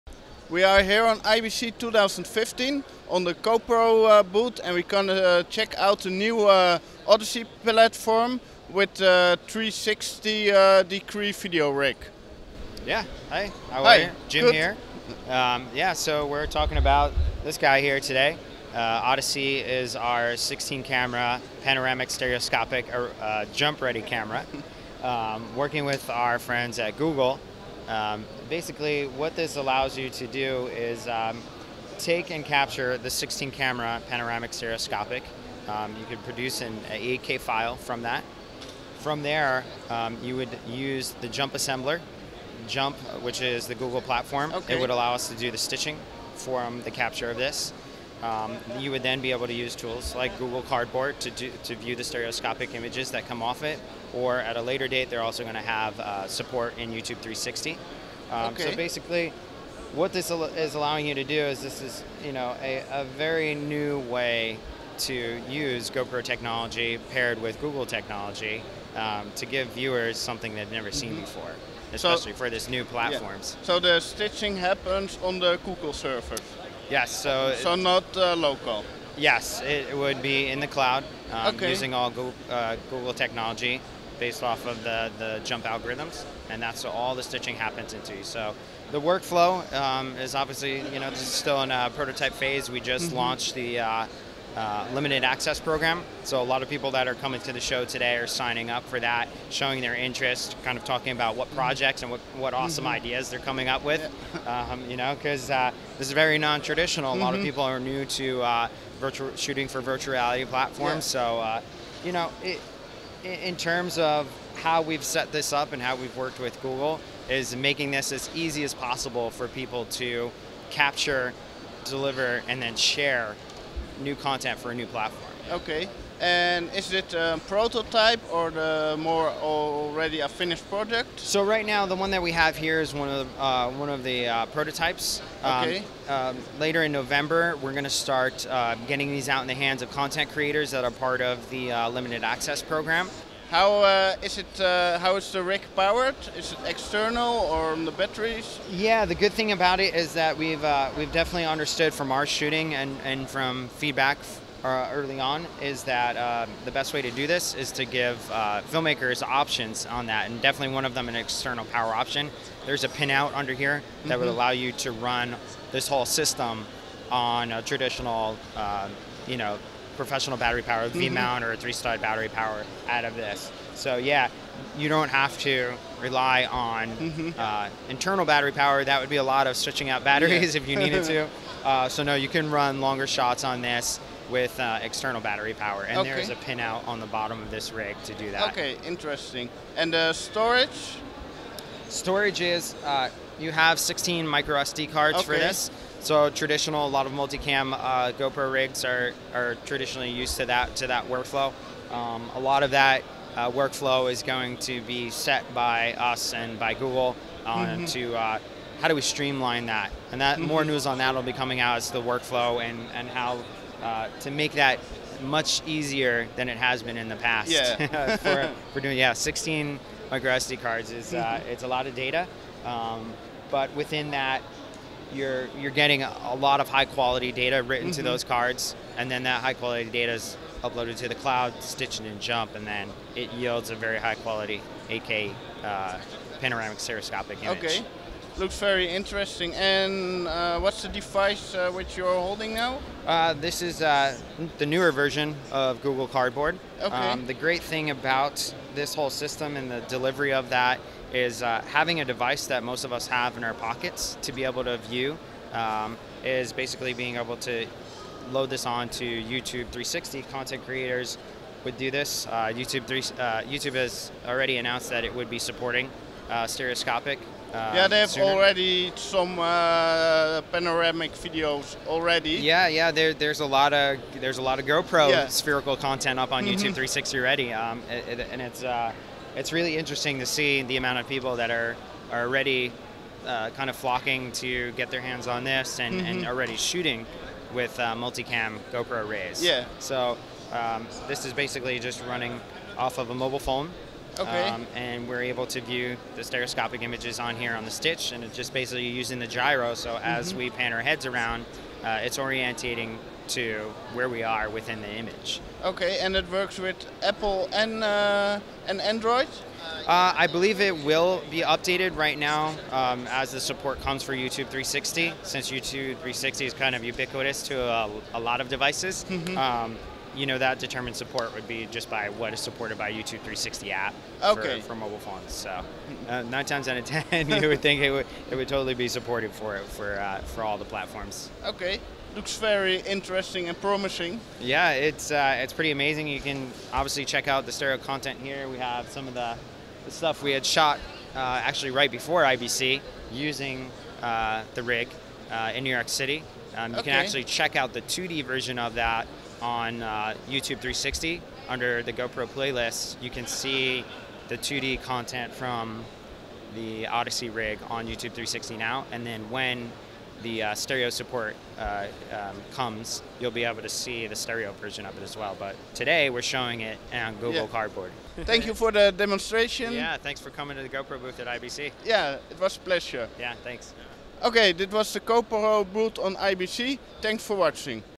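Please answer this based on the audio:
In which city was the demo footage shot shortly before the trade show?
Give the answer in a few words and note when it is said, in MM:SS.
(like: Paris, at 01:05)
New York City, at 05:45.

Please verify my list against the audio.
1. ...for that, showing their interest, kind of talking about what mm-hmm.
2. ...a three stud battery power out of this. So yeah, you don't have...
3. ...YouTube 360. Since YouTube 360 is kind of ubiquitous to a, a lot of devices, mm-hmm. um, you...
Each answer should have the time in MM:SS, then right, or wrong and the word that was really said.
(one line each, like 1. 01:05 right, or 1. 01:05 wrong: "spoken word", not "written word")
1. 01:38 right
2. 02:51 right
3. 05:14 right.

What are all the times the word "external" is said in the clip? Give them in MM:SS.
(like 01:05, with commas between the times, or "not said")
02:26, 02:41, 03:04.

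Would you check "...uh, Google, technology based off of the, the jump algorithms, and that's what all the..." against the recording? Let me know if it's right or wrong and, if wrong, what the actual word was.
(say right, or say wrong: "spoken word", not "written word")
right.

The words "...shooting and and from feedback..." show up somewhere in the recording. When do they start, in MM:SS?
02:32.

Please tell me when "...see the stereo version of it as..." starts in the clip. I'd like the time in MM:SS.
06:03.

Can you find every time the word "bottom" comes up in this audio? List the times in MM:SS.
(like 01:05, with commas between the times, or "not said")
03:07.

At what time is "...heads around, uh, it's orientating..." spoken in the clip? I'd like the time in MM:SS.
05:00.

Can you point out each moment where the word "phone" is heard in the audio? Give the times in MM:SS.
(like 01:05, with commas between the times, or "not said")
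04:53, 05:24.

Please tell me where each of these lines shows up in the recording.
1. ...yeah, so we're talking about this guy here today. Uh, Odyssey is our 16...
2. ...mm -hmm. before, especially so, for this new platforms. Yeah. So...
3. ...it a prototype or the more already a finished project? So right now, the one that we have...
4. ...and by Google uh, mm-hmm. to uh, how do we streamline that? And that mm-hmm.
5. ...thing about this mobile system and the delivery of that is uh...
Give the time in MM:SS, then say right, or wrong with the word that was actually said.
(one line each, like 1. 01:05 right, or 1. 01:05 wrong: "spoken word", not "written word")
1. 00:15 right
2. 01:11 right
3. 02:06 right
4. 03:26 right
5. 04:07 wrong: "whole", not "mobile".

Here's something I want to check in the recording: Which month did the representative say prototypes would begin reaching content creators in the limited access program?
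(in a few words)
November.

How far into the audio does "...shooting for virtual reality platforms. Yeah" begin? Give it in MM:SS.
01:49.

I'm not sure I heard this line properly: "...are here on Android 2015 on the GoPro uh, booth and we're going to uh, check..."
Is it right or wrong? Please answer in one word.
wrong.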